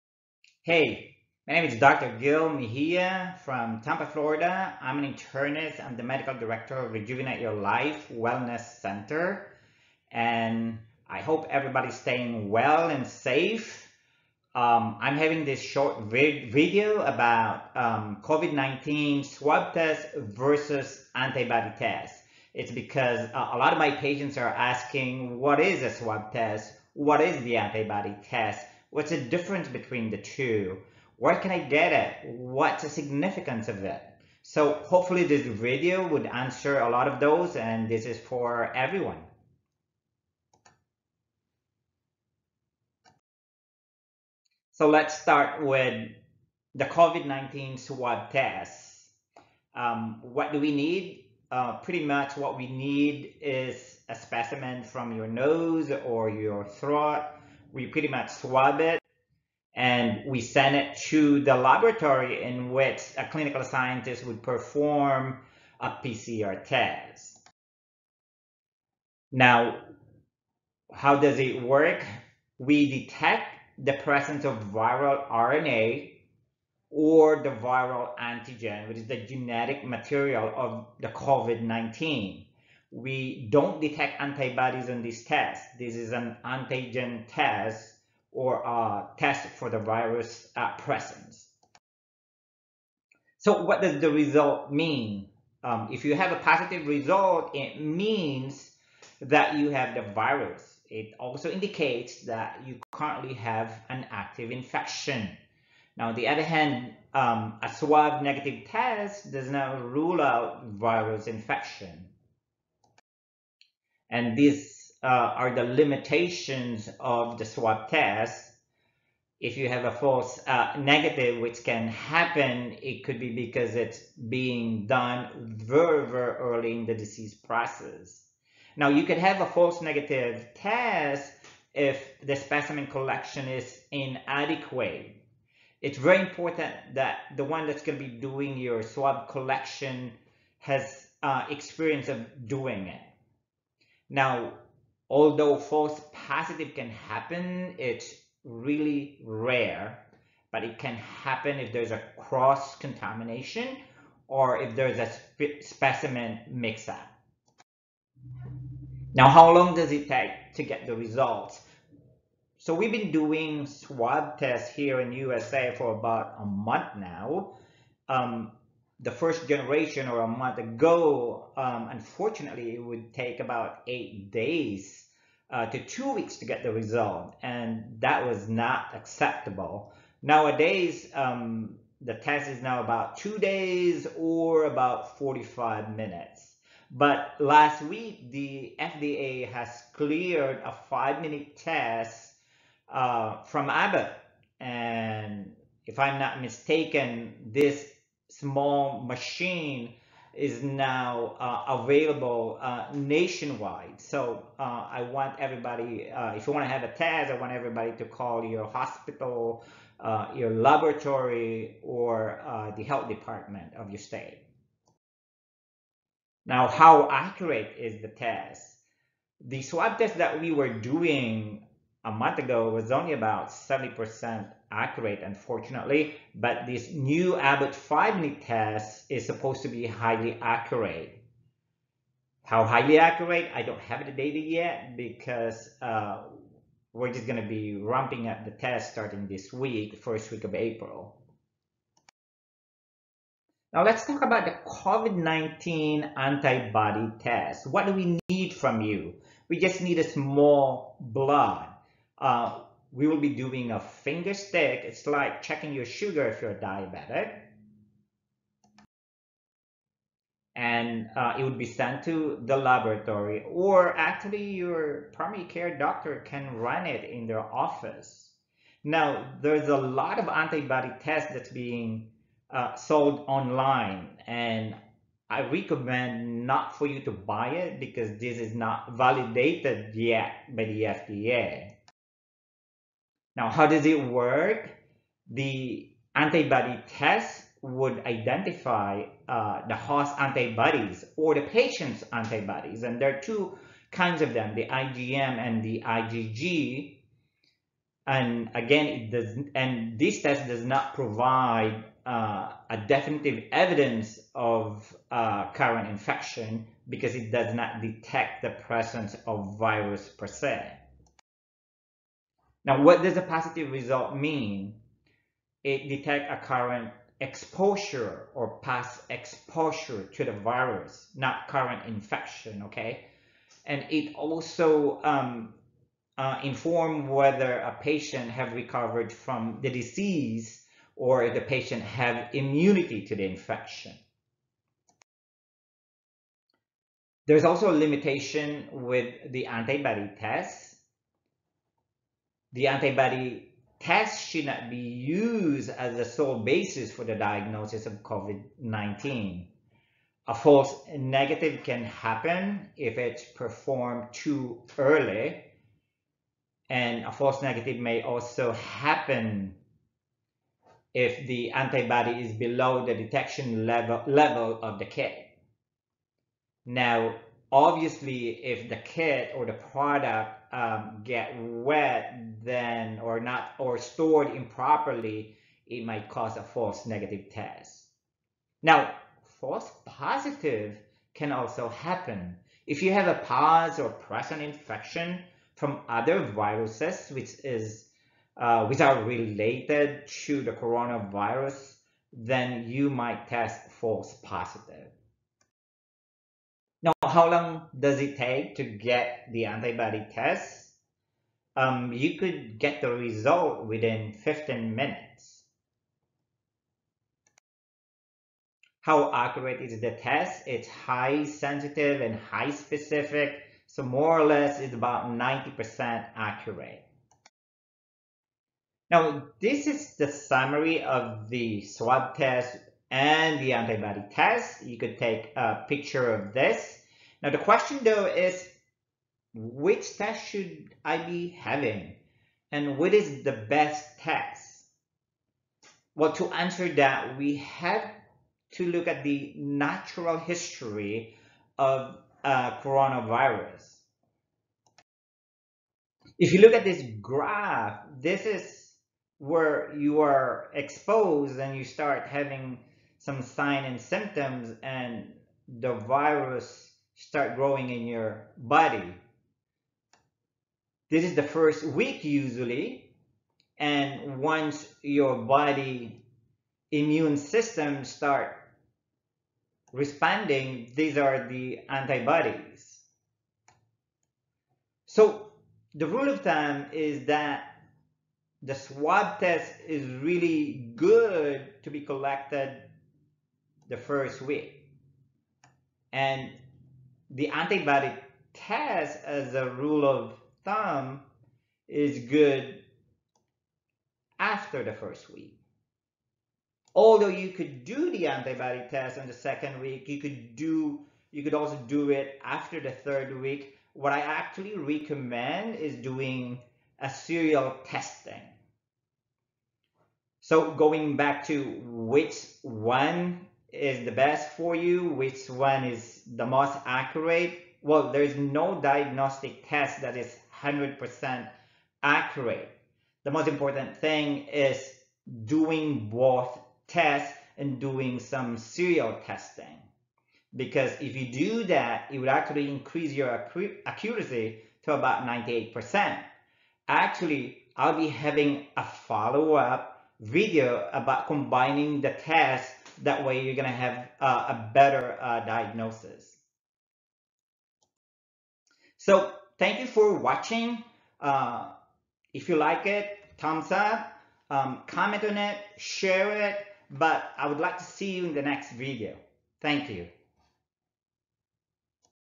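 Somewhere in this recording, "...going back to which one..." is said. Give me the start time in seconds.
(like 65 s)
510 s.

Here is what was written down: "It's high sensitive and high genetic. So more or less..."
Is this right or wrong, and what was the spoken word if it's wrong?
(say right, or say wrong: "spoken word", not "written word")
wrong: "specific", not "genetic".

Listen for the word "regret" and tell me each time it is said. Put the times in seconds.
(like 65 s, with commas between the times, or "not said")
not said.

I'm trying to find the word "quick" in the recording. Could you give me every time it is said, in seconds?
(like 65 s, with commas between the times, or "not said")
not said.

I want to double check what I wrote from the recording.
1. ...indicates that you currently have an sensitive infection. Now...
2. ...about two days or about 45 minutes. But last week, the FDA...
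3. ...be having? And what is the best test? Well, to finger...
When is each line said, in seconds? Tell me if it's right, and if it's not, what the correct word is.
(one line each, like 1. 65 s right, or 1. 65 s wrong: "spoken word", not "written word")
1. 101 s wrong: "active", not "sensitive"
2. 182 s right
3. 430 s wrong: "answer", not "finger".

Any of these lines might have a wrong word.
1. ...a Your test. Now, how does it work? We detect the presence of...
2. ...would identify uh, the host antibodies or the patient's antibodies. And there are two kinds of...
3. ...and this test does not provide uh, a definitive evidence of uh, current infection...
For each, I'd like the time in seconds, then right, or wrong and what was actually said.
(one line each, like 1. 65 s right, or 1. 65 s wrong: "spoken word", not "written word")
1. 65 s wrong: "PCR", not "Your"
2. 287 s right
3. 299 s right.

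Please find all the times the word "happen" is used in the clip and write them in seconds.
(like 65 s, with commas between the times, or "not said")
121 s, 146 s, 150 s, 351 s, 358 s, 381 s.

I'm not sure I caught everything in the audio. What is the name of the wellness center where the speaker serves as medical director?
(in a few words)
Rejuvenate Your Life Wellness Center.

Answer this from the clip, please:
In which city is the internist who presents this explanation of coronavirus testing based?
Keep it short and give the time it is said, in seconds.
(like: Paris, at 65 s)
Tampa, at 3 s.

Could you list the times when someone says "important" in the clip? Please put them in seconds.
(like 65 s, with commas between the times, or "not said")
136 s, 523 s.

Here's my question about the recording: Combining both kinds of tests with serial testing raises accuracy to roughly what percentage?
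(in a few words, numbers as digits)
98%.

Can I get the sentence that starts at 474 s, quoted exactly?
So the rule of thumb is that the swab test is really good to be collected the first week.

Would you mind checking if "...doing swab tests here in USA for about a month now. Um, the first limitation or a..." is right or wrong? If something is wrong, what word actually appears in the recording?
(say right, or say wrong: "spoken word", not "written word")
wrong: "generation", not "limitation".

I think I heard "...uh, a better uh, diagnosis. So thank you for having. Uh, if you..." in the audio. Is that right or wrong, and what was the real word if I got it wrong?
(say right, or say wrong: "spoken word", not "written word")
wrong: "watching", not "having".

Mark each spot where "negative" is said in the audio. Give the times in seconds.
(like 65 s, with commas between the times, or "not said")
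108 s, 120 s, 129 s, 350 s, 357 s, 376 s.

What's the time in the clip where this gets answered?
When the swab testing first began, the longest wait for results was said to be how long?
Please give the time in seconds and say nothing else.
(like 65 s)
175 s.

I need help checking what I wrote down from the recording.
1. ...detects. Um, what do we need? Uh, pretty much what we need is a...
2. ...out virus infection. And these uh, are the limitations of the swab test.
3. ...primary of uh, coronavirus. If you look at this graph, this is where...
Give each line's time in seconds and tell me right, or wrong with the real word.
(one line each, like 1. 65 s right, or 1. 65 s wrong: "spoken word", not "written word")
1. 48 s wrong: "tests", not "detects"
2. 110 s right
3. 440 s wrong: "history", not "primary".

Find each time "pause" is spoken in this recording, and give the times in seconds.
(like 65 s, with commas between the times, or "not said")
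383 s.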